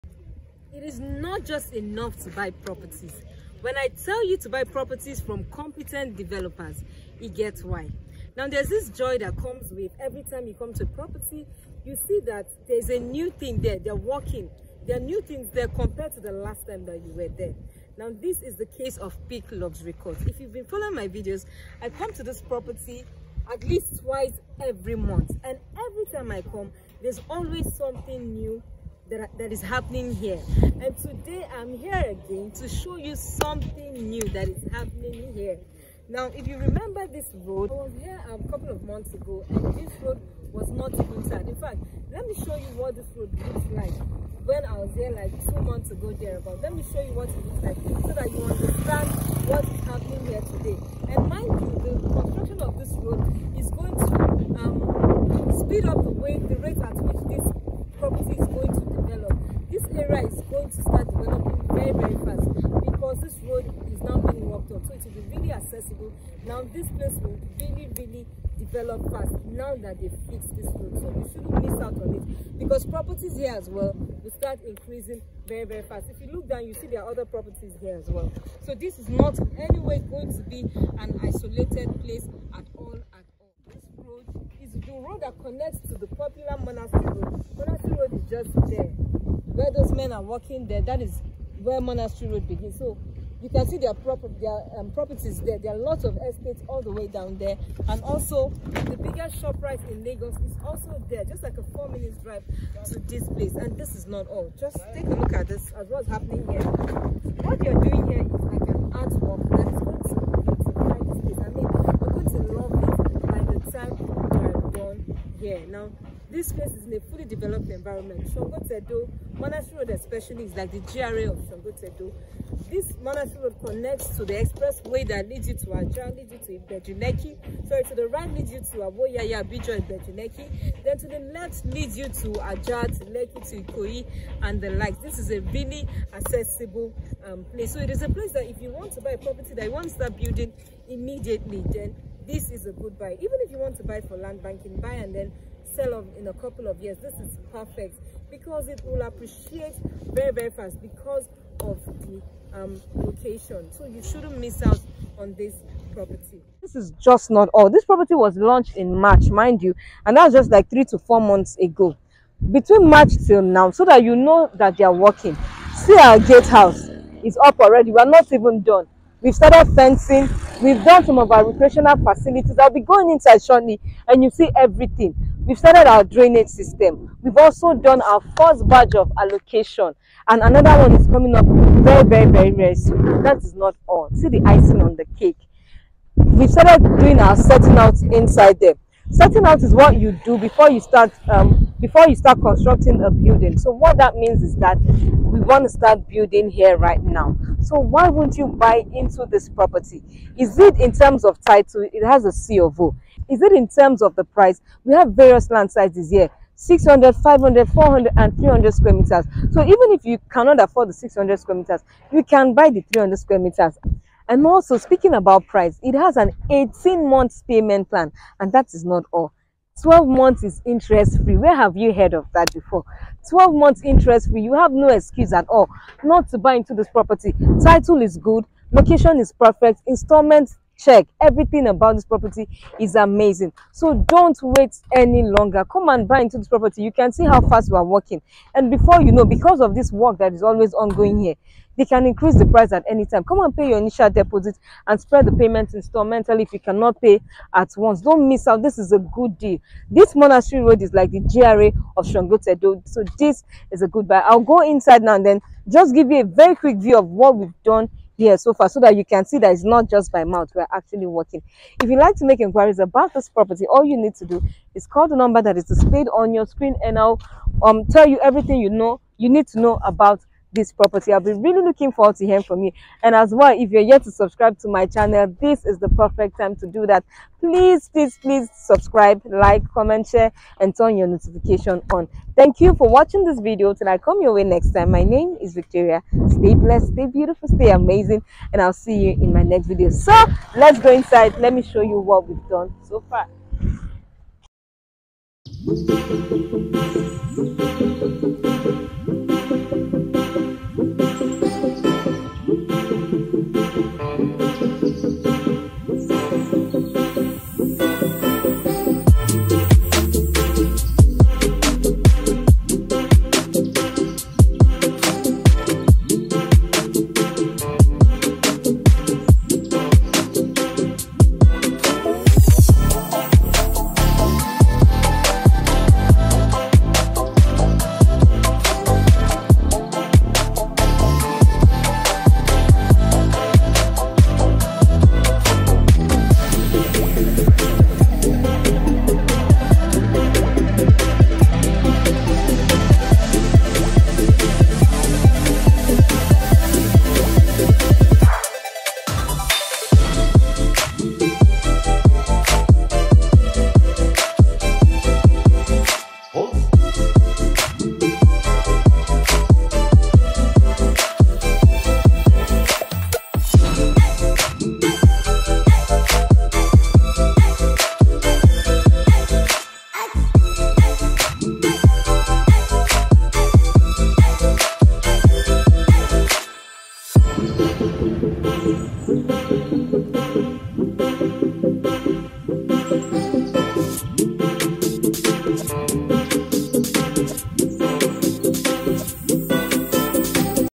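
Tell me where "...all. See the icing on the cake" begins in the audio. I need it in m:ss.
3:03.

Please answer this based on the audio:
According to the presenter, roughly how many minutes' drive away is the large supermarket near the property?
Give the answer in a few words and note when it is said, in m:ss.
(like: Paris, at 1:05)
4, at 1:41.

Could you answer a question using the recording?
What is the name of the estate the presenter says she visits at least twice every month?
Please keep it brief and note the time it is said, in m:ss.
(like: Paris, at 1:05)
Peak Luxury Court, at 0:19.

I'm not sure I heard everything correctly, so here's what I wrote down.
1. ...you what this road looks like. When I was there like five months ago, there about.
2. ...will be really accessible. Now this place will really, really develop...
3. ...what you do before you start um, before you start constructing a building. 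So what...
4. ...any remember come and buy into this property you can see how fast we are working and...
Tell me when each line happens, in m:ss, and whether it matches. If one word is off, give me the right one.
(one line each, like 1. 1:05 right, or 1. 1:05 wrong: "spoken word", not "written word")
1. 0:42 wrong: "two", not "five"
2. 1:05 right
3. 3:09 right
4. 3:54 wrong: "longer", not "remember".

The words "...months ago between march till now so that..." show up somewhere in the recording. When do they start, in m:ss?
2:41.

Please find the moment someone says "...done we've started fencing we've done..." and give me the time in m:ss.
2:48.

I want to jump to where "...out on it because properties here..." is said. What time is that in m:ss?
1:11.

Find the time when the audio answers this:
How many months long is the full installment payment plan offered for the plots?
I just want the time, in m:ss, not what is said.
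3:36.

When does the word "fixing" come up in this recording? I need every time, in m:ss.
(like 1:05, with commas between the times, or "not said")
not said.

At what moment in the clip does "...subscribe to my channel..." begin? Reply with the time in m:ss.
4:34.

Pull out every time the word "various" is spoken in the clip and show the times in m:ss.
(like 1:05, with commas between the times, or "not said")
3:25.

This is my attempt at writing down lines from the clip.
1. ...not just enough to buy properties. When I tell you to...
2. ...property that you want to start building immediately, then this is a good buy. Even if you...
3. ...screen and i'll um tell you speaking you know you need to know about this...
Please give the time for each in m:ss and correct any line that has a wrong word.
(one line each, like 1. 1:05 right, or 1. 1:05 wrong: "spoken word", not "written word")
1. 0:01 right
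2. 2:19 right
3. 4:26 wrong: "everything", not "speaking".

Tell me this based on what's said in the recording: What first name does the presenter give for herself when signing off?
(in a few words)
Victoria.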